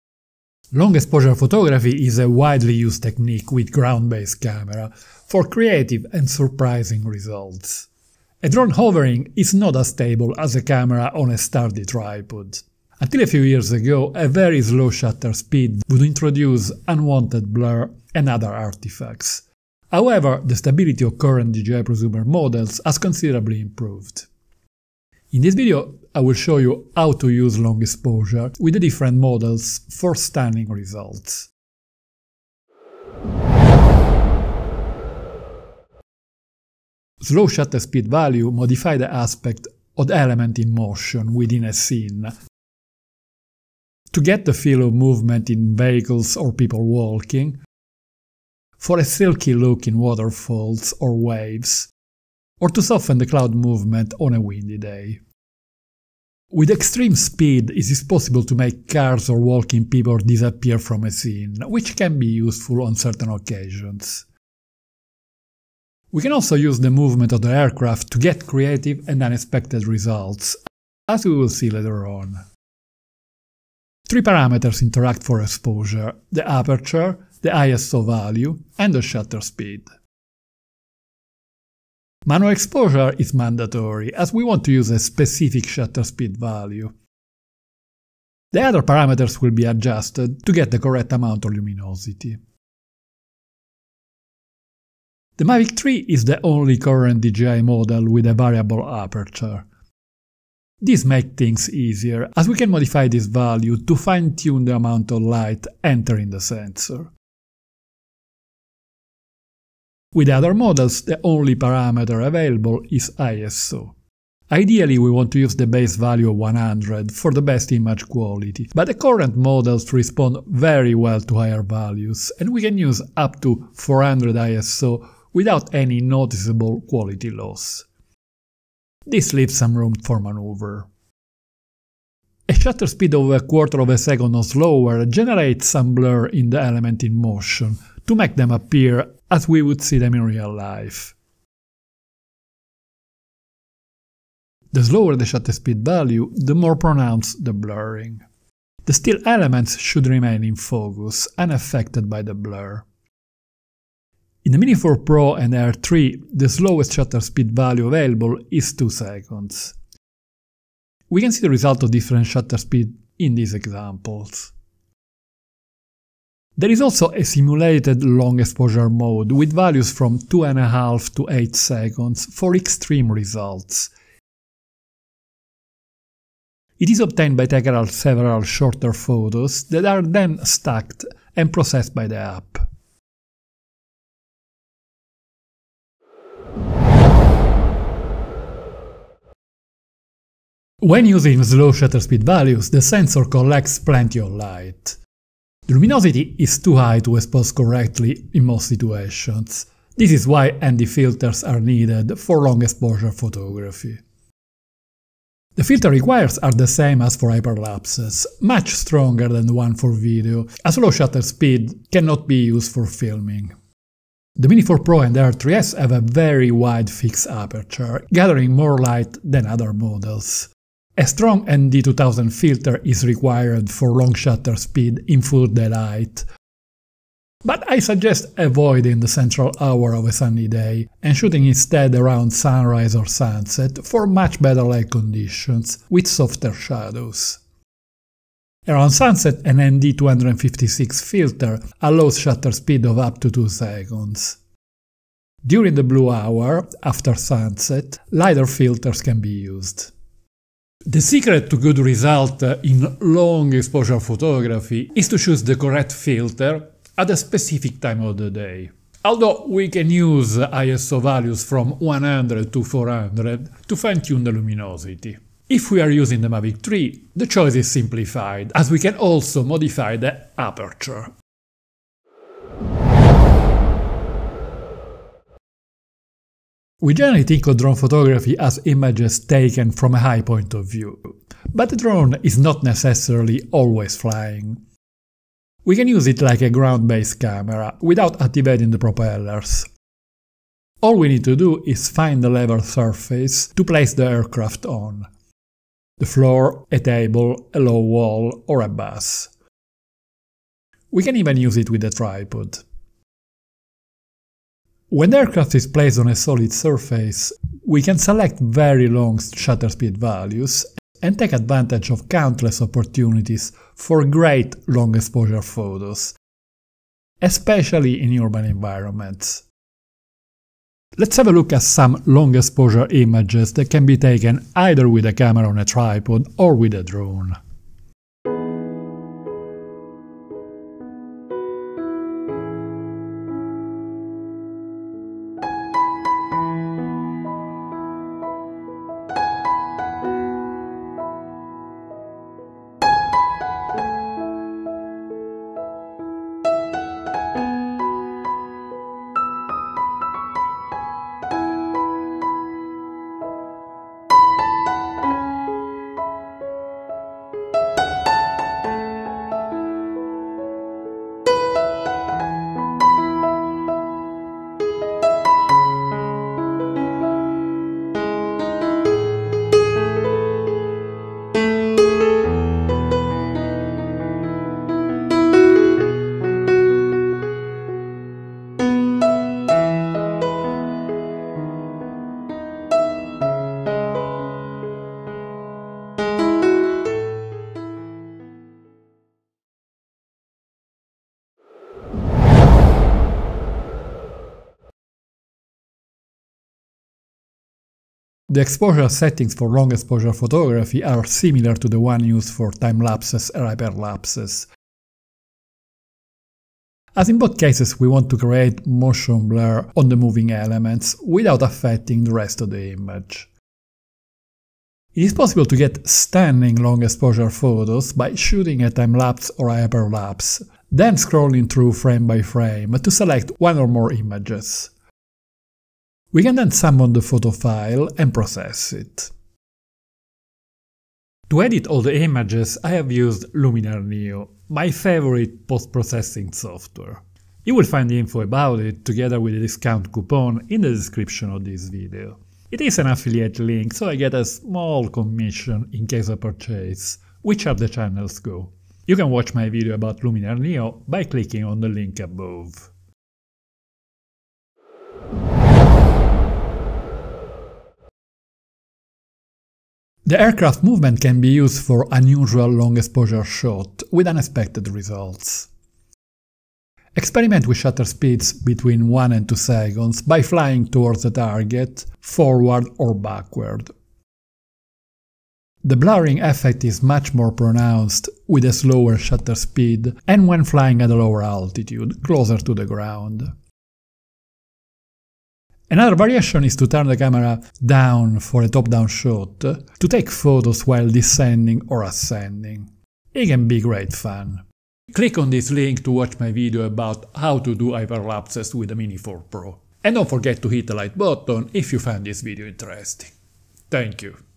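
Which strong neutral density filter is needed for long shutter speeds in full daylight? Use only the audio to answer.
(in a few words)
ND2000.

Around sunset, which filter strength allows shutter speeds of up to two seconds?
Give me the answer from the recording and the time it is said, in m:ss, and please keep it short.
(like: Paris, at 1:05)
ND256, at 3:59.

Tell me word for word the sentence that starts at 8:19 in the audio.
And don't forget to hit the like button if you found this video interesting.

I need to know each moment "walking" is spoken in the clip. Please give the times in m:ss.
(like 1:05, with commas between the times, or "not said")
0:46, 0:59.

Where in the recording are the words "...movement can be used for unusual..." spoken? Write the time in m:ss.
7:40.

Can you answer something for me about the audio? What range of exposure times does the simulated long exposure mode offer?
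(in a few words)
2.5 to 8 seconds.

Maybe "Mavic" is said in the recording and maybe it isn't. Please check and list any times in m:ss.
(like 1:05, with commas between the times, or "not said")
1:35, 4:26.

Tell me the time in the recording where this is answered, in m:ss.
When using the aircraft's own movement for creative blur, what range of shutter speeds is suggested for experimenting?
7:48.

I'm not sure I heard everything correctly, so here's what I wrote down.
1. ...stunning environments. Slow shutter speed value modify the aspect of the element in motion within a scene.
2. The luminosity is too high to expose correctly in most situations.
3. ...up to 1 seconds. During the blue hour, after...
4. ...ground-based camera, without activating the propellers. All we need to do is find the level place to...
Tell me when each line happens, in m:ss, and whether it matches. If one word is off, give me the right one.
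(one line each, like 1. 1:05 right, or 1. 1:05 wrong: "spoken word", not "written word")
1. 0:30 wrong: "results", not "environments"
2. 3:15 right
3. 4:02 wrong: "2", not "1"
4. 4:46 wrong: "surface", not "place".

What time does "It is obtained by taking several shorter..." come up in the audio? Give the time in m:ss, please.
2:56.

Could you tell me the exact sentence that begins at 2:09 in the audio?
This leaves some room for maneuver.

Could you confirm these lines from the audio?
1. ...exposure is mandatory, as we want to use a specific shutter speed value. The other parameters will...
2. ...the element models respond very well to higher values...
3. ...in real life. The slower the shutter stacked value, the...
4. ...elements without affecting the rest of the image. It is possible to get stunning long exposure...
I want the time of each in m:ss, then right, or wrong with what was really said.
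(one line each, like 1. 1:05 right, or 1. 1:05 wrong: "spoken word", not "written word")
1. 1:22 right
2. 1:58 wrong: "current", not "element"
3. 2:20 wrong: "speed", not "stacked"
4. 6:50 right.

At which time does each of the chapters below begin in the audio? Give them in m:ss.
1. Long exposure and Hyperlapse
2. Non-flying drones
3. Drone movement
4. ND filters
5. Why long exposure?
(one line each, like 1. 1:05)
1. 6:31
2. 4:31
3. 7:34
4. 3:05
5. 0:32.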